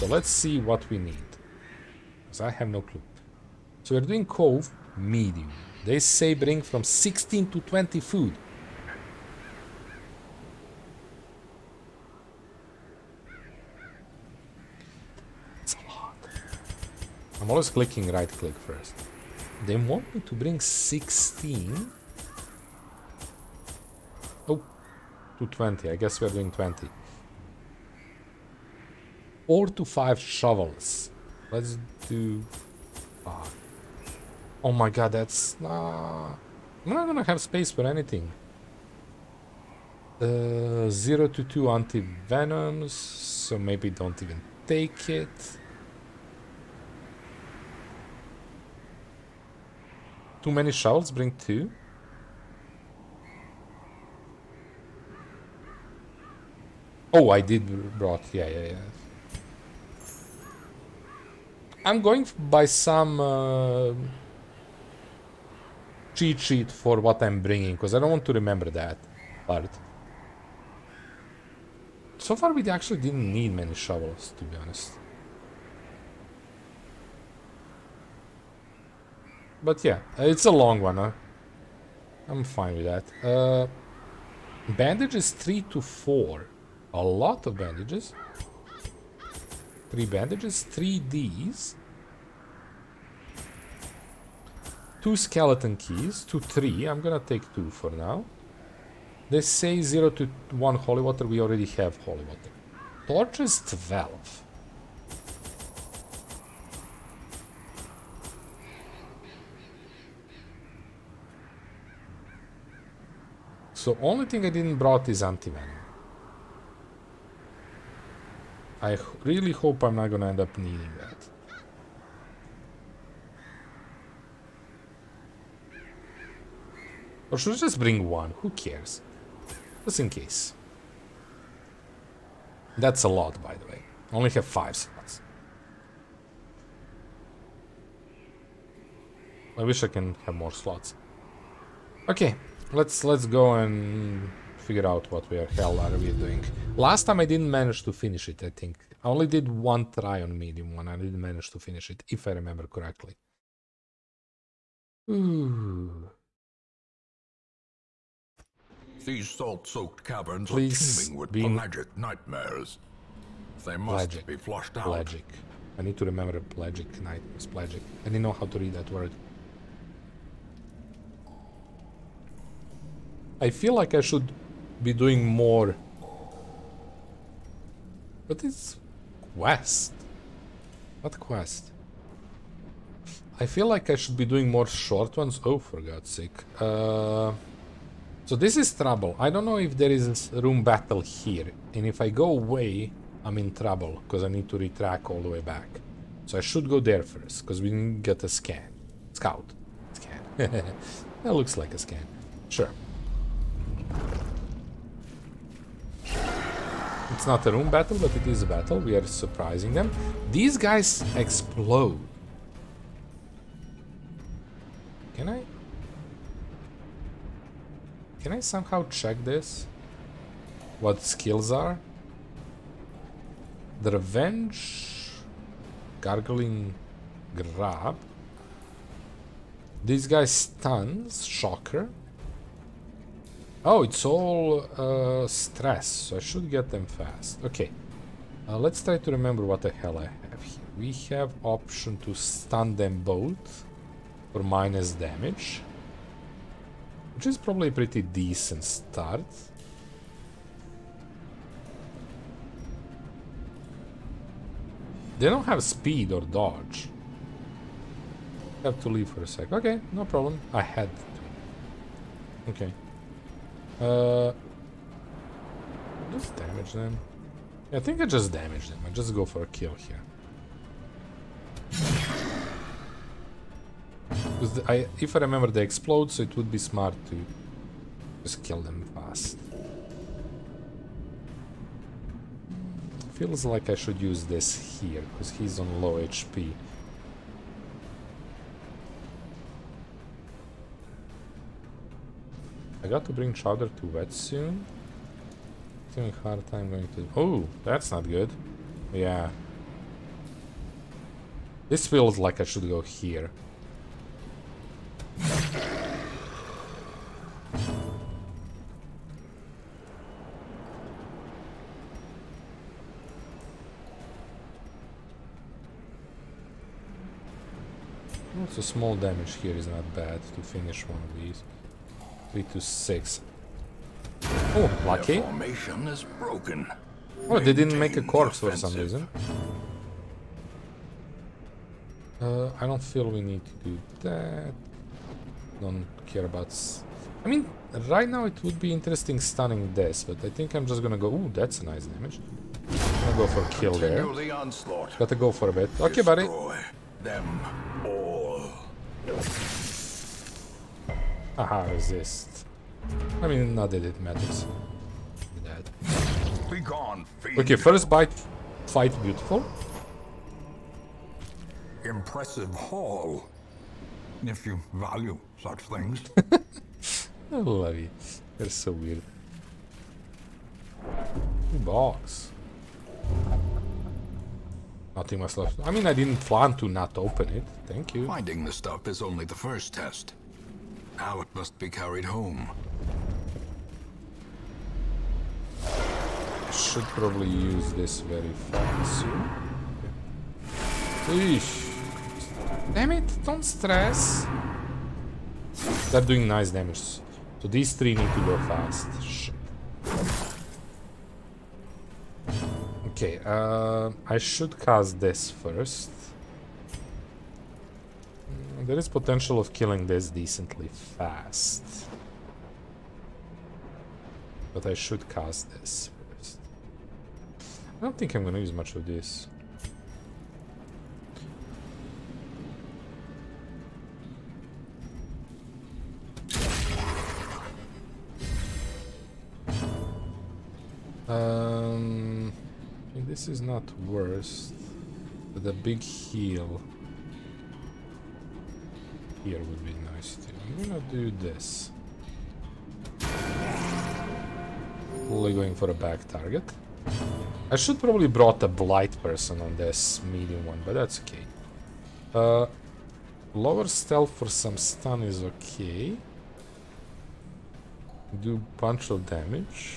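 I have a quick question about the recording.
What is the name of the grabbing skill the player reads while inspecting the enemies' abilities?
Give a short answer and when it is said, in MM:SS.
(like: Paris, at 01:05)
Gargling Grab, at 03:45.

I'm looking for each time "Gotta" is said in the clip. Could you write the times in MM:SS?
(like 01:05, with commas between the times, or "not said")
05:44.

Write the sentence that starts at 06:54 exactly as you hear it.
But I should cast this first.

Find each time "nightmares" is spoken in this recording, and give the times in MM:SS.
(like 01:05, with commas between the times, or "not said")
02:41, 02:47.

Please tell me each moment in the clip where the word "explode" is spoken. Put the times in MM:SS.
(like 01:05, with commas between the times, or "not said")
03:31, 04:35.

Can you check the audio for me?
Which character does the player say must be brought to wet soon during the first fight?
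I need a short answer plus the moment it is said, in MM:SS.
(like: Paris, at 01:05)
Chowder, at 04:53.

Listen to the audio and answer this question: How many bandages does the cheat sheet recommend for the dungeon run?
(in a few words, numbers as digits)
3 to 4.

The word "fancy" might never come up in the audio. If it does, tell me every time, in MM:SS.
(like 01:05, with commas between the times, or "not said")
06:28.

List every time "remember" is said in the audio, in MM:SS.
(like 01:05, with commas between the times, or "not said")
01:08, 02:32, 02:46, 03:59, 04:35.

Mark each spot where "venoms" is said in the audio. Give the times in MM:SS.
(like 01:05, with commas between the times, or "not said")
00:41, 01:55.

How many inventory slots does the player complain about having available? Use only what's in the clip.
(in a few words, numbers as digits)
five.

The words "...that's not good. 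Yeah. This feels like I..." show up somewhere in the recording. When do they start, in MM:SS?
04:57.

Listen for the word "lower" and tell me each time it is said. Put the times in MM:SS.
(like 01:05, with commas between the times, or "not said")
07:33.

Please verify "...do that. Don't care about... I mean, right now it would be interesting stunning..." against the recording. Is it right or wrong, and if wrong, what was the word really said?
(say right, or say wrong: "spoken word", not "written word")
right.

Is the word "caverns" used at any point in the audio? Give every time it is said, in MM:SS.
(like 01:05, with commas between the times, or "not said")
02:40.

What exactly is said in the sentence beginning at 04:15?
They don't have speed or dodge.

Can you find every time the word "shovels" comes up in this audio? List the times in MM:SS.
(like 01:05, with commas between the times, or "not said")
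00:30, 00:50, 01:13.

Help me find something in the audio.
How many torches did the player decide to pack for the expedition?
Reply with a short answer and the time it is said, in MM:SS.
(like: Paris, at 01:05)
12, at 01:43.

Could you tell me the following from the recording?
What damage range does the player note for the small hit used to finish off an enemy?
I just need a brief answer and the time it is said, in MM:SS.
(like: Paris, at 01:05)
3 to 6, at 05:22.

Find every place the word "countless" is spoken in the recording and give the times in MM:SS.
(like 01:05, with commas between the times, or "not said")
not said.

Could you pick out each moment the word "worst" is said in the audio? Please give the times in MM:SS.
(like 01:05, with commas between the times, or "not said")
07:13.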